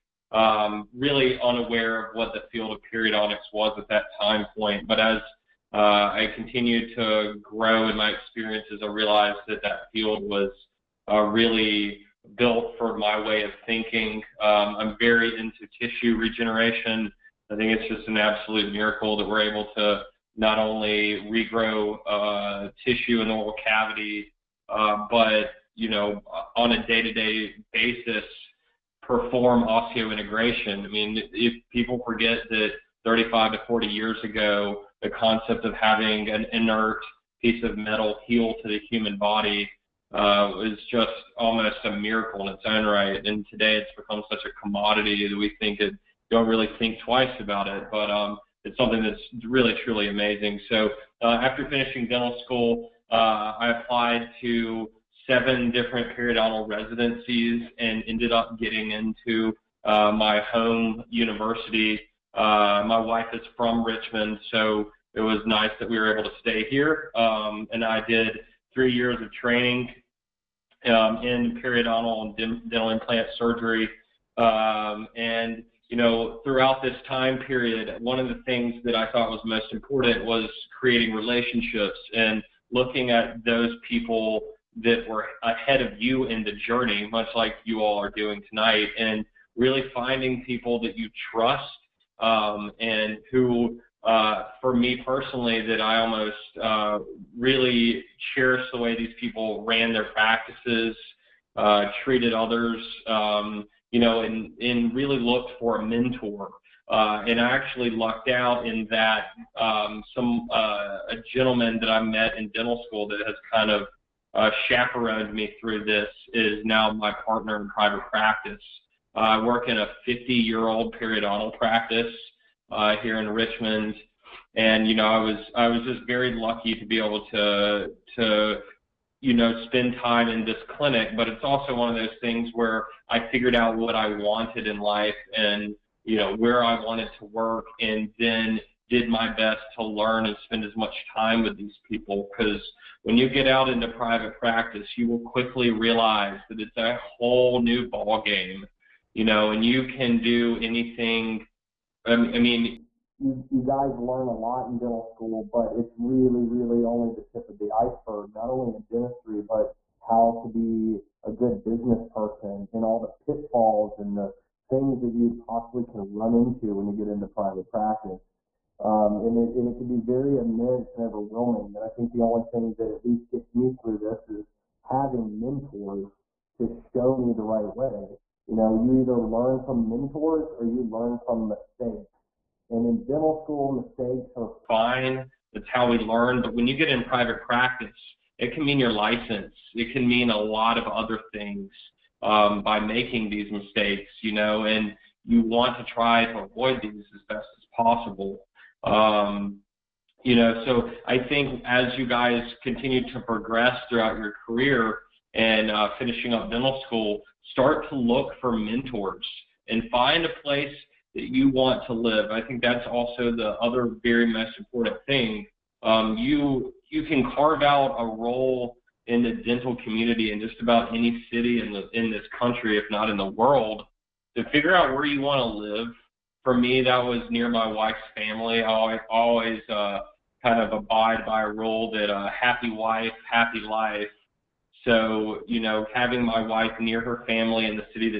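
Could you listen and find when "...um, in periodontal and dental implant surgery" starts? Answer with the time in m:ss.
1:10.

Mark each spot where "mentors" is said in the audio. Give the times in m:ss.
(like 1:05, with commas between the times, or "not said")
1:45, 2:55, 2:59, 3:28.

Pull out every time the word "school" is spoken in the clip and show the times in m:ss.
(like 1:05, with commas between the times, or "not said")
0:52, 1:52, 2:35, 3:03, 3:26.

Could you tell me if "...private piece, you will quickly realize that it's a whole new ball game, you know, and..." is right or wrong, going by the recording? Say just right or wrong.
wrong.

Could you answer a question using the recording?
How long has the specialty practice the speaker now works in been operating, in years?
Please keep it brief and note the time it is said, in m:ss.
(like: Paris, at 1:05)
50, at 2:00.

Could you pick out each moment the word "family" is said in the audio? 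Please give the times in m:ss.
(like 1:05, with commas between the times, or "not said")
3:48, 3:57.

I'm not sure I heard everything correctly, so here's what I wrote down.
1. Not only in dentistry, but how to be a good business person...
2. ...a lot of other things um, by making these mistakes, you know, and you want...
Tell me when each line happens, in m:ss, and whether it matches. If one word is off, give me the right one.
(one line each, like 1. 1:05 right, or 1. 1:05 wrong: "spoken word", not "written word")
1. 2:38 right
2. 3:10 right.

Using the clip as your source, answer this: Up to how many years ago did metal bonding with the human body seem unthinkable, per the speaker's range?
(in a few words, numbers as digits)
40.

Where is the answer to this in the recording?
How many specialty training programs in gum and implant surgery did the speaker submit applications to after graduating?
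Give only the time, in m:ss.
0:55.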